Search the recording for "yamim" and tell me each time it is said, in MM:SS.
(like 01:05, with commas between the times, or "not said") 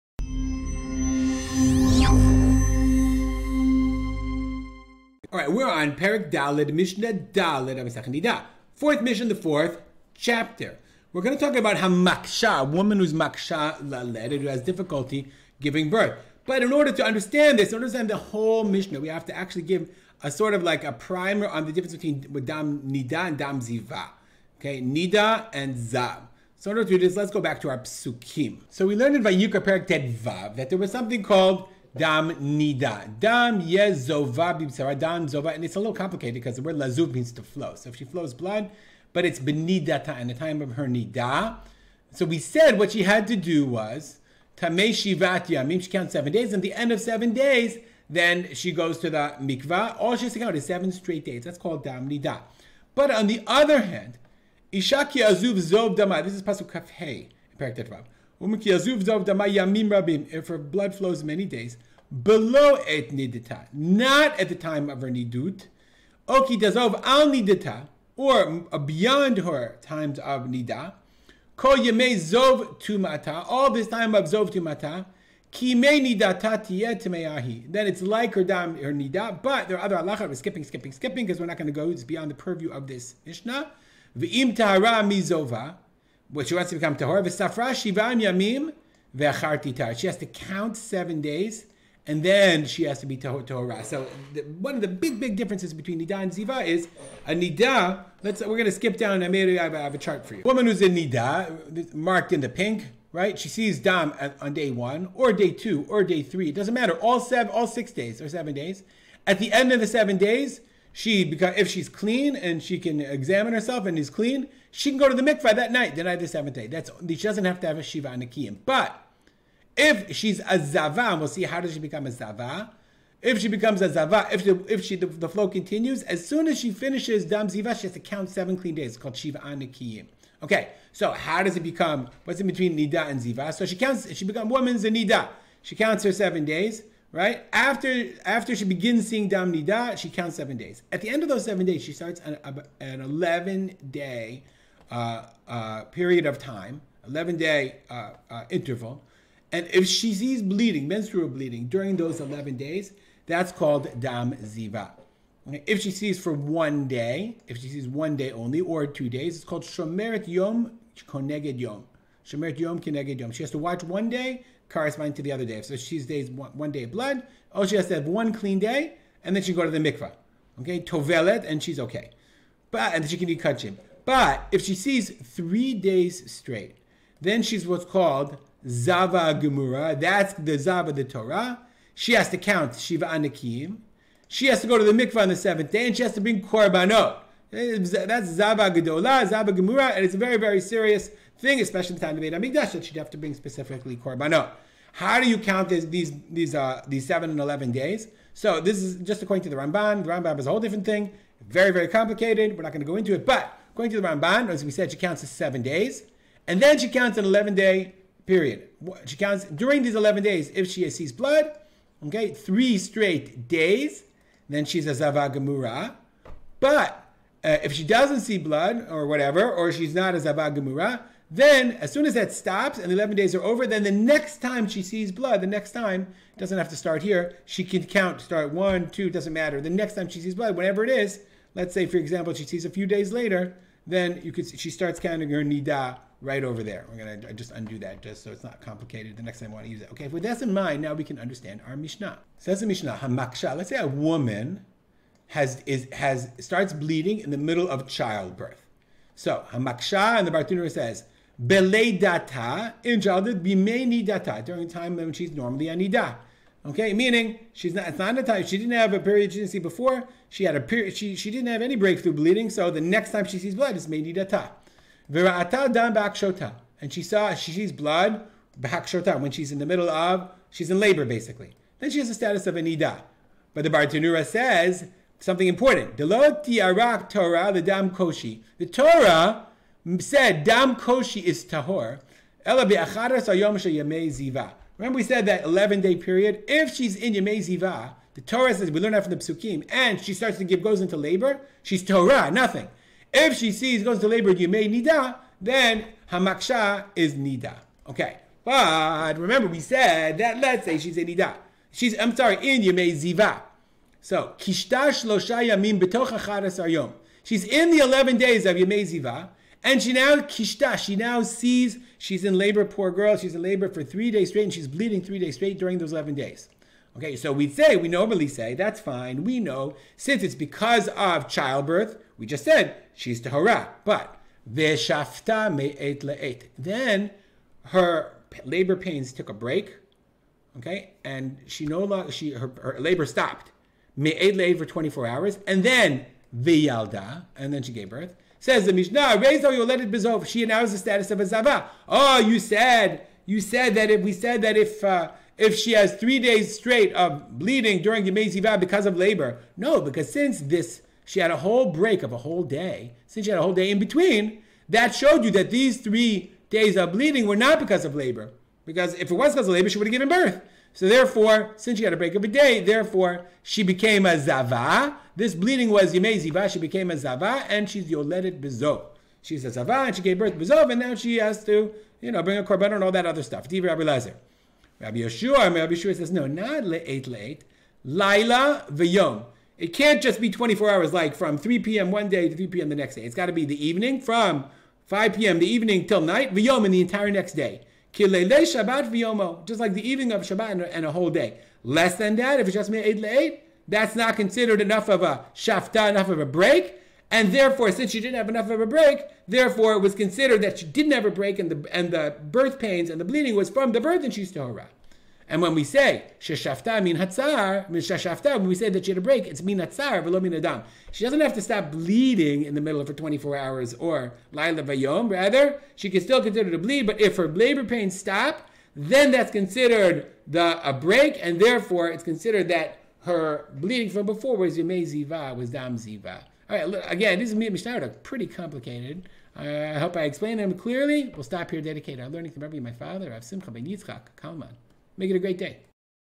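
00:45, 01:28, 05:05.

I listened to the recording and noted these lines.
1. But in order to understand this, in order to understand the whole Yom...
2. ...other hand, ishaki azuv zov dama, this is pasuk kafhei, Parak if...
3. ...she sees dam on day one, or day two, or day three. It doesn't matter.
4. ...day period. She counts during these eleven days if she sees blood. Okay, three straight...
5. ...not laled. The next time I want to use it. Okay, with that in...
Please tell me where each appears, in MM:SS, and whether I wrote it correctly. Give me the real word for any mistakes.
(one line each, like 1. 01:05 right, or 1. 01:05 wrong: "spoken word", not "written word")
1. 00:16 wrong: "Mishnah", not "Yom"
2. 00:53 right
3. 01:43 right
4. 03:27 right
5. 03:58 wrong: "complicated", not "laled".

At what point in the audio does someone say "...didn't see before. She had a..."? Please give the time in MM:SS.
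04:19.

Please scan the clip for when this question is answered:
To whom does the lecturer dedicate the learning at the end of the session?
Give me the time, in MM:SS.
07:13.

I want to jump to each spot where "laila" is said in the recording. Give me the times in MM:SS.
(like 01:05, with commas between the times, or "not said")
06:17, 06:54.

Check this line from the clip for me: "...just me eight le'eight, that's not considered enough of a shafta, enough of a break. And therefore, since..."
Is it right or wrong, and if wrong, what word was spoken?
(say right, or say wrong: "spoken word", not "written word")
right.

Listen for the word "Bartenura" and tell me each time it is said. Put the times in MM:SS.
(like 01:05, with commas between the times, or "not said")
04:10, 04:33.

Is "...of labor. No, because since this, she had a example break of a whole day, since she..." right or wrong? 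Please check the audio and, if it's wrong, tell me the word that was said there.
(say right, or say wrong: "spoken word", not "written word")
wrong: "whole", not "example".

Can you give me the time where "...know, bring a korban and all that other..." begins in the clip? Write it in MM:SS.
06:12.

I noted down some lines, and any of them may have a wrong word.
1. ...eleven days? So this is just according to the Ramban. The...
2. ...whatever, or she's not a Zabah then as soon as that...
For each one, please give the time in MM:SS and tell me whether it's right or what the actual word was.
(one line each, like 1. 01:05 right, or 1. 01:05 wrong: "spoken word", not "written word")
1. 03:17 right
2. 03:39 right.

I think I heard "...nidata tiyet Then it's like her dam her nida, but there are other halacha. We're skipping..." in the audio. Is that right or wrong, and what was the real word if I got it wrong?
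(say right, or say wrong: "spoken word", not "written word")
right.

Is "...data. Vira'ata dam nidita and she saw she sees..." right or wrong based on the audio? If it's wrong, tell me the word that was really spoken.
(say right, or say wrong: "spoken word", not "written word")
wrong: "bakshota", not "nidita".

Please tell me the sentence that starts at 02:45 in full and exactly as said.
So she's days one, one day of blood.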